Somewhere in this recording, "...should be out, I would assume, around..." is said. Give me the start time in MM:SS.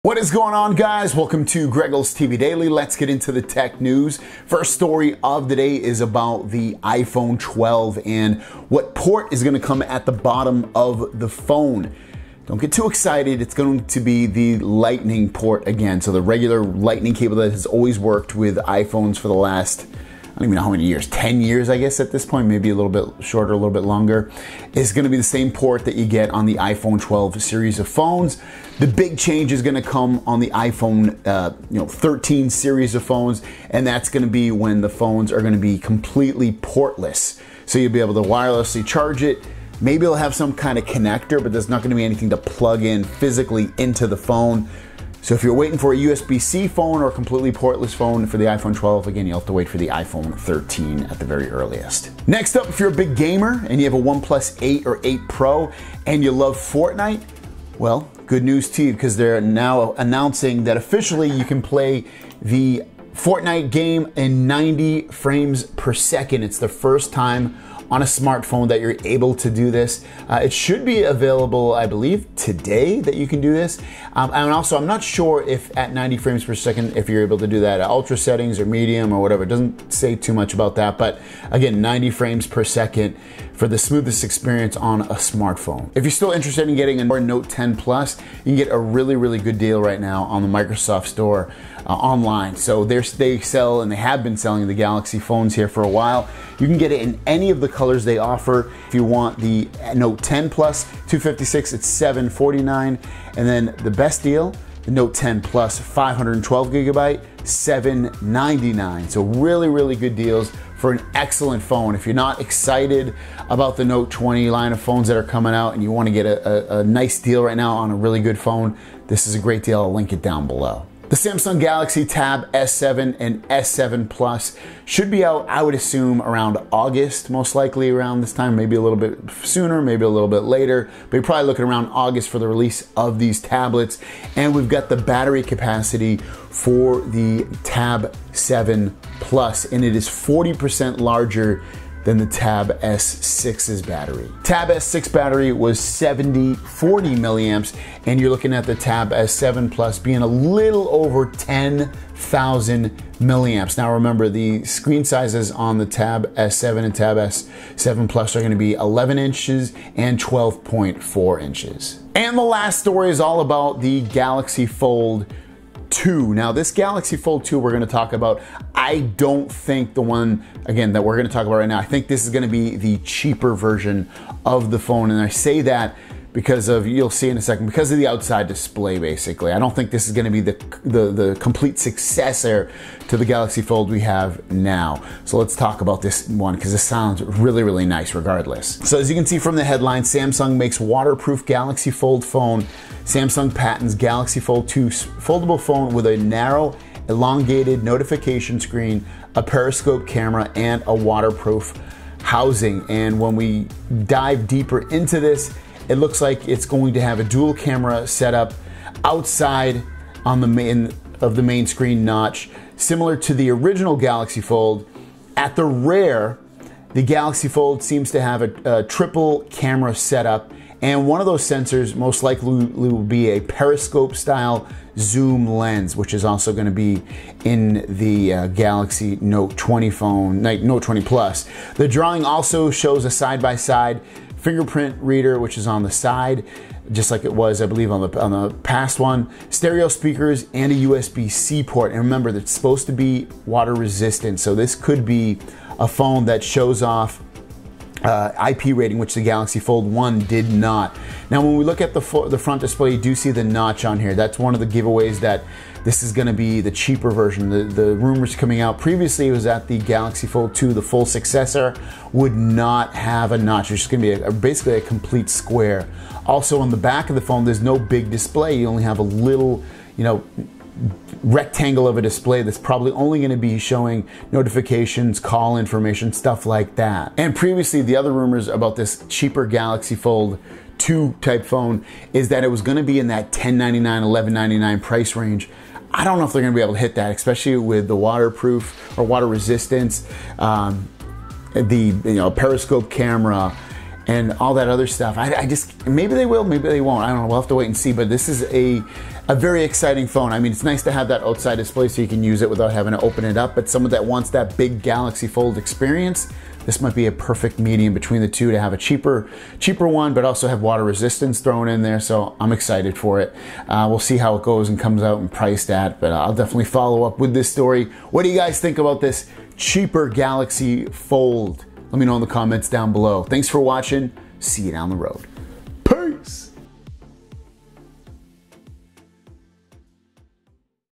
02:04.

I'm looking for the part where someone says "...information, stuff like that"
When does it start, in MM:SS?
04:35.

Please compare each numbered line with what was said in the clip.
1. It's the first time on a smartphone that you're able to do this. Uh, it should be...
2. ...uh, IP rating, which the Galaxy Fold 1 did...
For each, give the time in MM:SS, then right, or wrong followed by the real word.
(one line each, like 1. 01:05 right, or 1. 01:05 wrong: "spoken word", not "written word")
1. 01:06 right
2. 04:08 right.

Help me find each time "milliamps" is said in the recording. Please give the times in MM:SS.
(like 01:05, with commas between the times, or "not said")
02:27, 02:33.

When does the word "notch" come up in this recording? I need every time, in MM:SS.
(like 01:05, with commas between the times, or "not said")
03:32, 04:13, 04:23.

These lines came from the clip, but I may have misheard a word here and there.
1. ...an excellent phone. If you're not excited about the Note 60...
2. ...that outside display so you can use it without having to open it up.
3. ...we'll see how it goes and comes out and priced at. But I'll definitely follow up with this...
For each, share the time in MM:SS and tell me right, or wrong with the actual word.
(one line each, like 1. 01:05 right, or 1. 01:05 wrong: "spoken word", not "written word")
1. 01:50 wrong: "20", not "60"
2. 05:01 right
3. 05:13 right.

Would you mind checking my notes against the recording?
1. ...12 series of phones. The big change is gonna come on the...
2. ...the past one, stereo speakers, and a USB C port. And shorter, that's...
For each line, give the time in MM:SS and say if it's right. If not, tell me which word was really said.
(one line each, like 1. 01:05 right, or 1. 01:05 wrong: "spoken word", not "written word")
1. 00:26 right
2. 03:58 wrong: "remember", not "shorter".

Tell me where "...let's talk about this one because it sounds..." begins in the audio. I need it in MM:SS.
03:05.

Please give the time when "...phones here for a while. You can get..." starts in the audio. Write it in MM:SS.
01:35.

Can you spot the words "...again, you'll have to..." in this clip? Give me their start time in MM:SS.
00:49.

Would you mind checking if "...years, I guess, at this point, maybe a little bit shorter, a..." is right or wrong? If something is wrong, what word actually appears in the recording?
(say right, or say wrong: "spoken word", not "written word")
right.